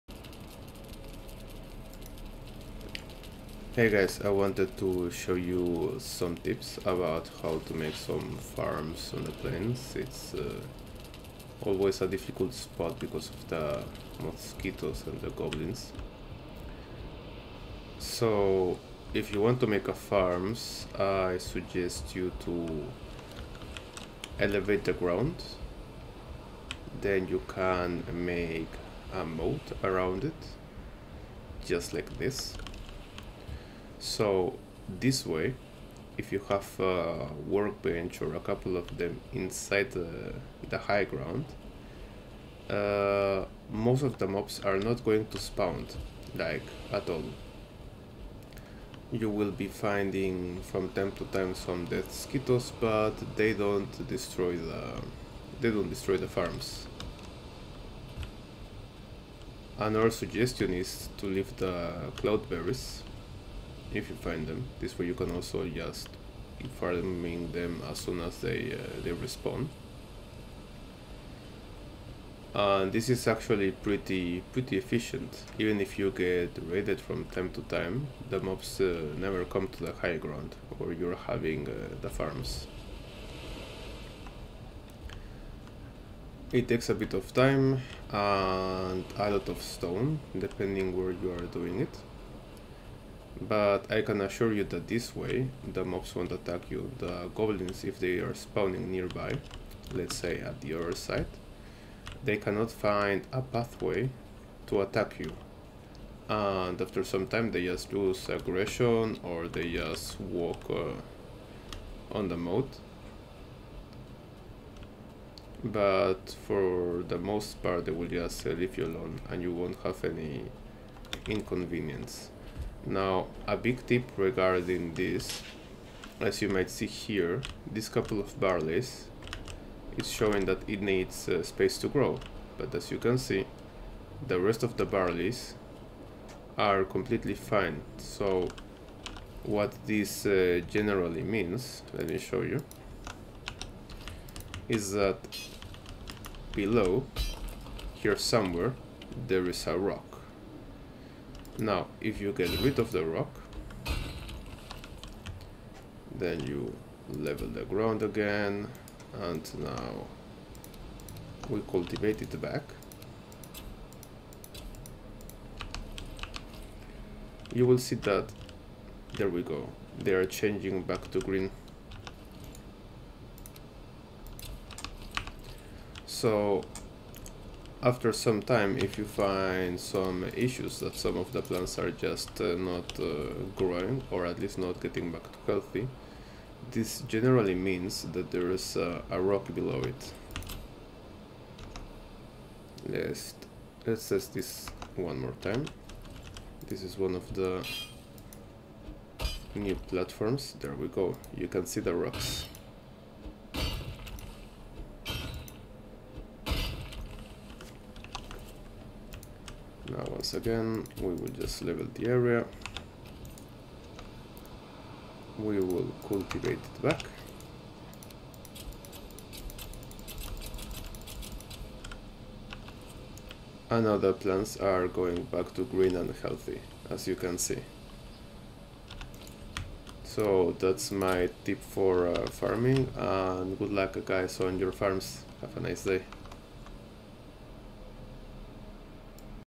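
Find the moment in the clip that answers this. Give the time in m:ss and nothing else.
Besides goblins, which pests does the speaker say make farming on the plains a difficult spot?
0:14.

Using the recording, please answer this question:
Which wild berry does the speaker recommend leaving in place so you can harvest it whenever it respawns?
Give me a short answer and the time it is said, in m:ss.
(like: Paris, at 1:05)
cloudberries, at 1:02.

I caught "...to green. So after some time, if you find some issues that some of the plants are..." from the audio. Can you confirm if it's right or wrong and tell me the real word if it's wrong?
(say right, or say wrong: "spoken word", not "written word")
right.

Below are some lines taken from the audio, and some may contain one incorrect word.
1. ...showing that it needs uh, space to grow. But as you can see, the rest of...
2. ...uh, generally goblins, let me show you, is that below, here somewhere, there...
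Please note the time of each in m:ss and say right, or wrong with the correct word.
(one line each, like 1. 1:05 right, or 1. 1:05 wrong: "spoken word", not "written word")
1. 2:10 right
2. 2:20 wrong: "means", not "goblins".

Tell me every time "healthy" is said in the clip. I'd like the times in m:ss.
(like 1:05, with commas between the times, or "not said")
3:05, 3:46.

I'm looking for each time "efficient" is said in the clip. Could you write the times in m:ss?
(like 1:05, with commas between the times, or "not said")
1:14.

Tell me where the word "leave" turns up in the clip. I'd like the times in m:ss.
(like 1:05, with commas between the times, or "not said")
1:01, 1:58.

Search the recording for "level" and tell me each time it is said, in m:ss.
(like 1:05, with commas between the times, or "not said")
2:37, 3:31.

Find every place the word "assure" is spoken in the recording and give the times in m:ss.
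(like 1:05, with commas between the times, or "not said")
1:34.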